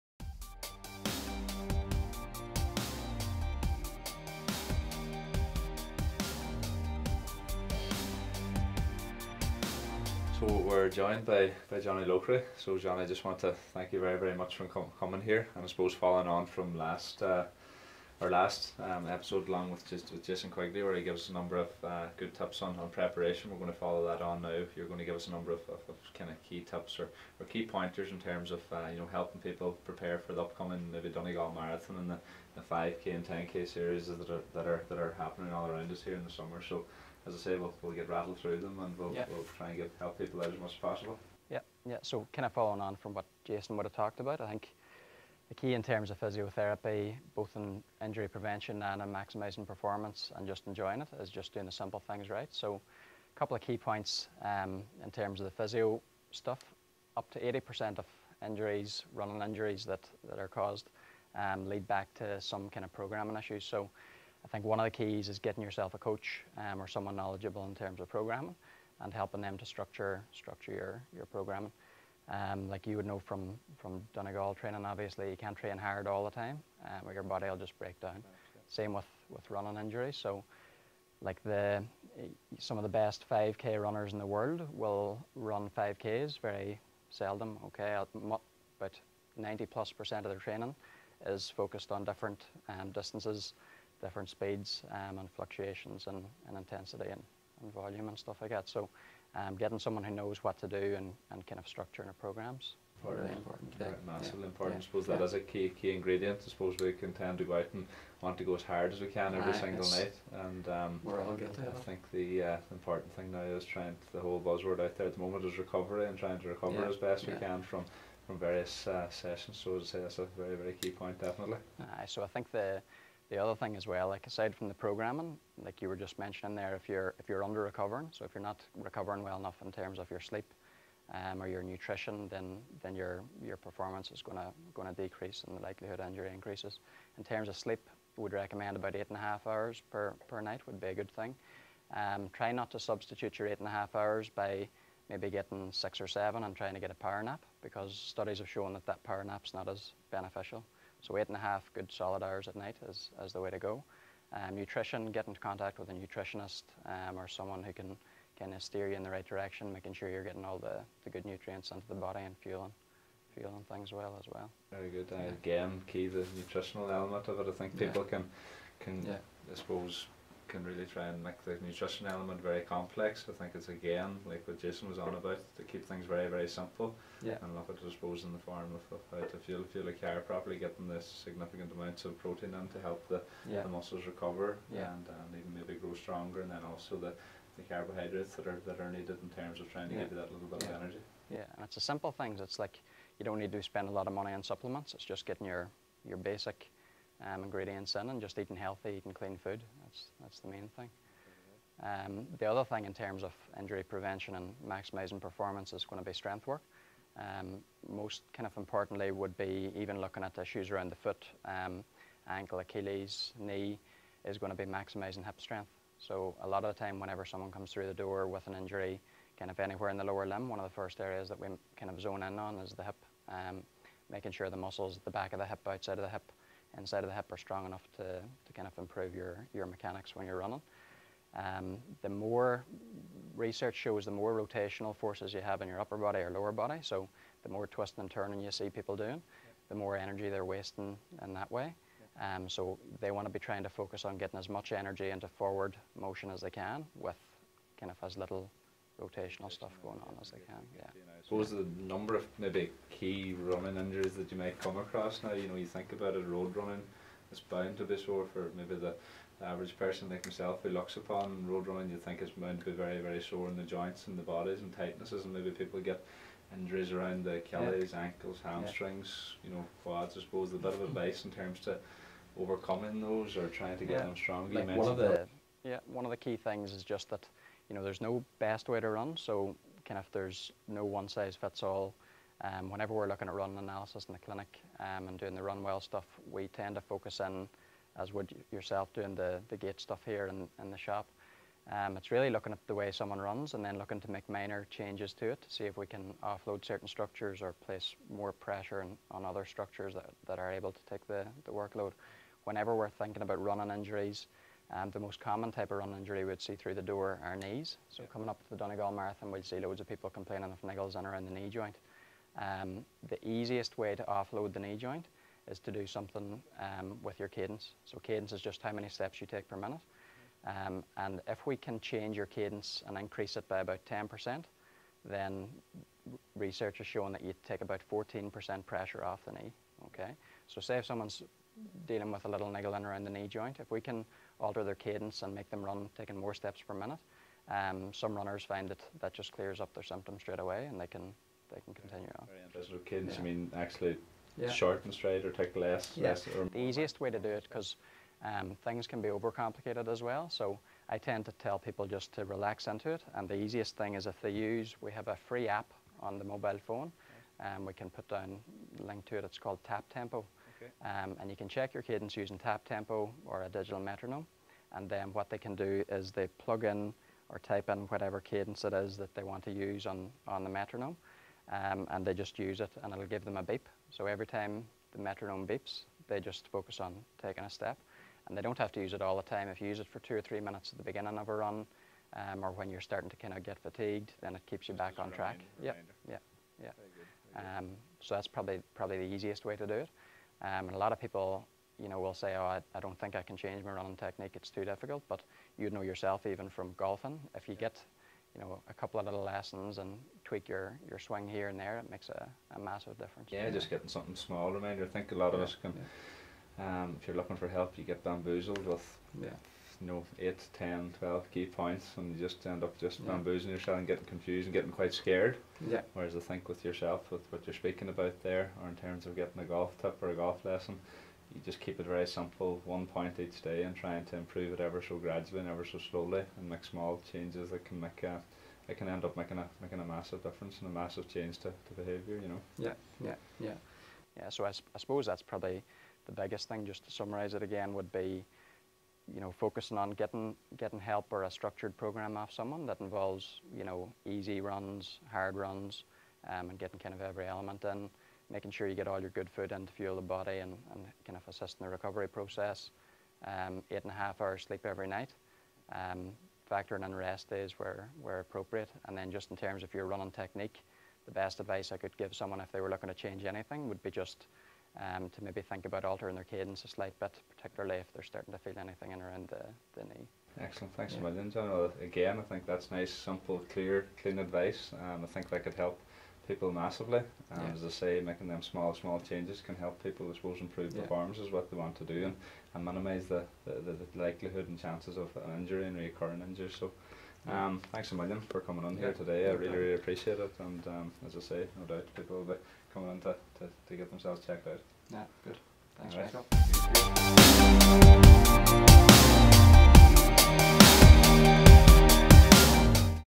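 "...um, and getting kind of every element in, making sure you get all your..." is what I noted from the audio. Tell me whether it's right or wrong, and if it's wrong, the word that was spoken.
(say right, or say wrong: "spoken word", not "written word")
right.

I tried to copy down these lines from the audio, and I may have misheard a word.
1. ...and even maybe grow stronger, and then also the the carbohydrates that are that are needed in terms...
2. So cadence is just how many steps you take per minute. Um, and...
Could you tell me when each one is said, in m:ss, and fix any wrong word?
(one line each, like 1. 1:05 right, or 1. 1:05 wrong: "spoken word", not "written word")
1. 3:05 right
2. 5:17 right.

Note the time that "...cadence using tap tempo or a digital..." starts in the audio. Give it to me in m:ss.
6:01.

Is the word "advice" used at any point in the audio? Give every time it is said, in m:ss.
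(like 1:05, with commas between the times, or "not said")
4:30, 7:41, 7:54.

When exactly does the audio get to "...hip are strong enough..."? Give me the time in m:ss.
3:47.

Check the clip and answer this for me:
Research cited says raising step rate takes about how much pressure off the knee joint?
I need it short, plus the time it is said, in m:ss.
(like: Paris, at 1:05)
14%, at 5:27.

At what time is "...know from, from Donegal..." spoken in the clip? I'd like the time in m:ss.
1:13.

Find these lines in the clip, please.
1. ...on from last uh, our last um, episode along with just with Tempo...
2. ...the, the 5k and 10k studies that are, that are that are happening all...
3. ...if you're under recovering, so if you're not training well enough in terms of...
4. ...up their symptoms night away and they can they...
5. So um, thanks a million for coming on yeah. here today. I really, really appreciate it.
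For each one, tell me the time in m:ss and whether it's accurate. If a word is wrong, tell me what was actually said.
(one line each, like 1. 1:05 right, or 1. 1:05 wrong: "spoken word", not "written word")
1. 0:16 wrong: "Jason", not "Tempo"
2. 0:32 wrong: "series", not "studies"
3. 2:07 wrong: "recovering", not "training"
4. 5:39 wrong: "straight", not "night"
5. 8:06 right.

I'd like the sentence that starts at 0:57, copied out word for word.
Up to 80% of injuries, running injuries that, that are caused, um, lead back to some kind of programming issues.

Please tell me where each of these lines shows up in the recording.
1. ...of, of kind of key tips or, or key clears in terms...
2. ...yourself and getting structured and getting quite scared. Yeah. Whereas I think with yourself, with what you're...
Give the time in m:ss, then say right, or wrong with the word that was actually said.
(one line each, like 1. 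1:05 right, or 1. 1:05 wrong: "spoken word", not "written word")
1. 0:25 wrong: "pointers", not "clears"
2. 6:53 wrong: "confused", not "structured".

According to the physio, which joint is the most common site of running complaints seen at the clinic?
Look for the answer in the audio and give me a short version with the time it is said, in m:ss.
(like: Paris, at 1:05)
Knees, at 5:07.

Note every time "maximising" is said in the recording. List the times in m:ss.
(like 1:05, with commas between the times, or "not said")
0:49, 3:24, 3:34.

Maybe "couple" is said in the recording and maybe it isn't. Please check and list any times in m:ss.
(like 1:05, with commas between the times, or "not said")
0:53, 6:38.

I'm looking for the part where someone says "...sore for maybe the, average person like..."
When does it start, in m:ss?
4:17.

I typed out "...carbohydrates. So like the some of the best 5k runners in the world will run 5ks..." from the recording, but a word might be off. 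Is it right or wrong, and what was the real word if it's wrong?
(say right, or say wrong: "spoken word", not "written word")
wrong: "injuries", not "carbohydrates".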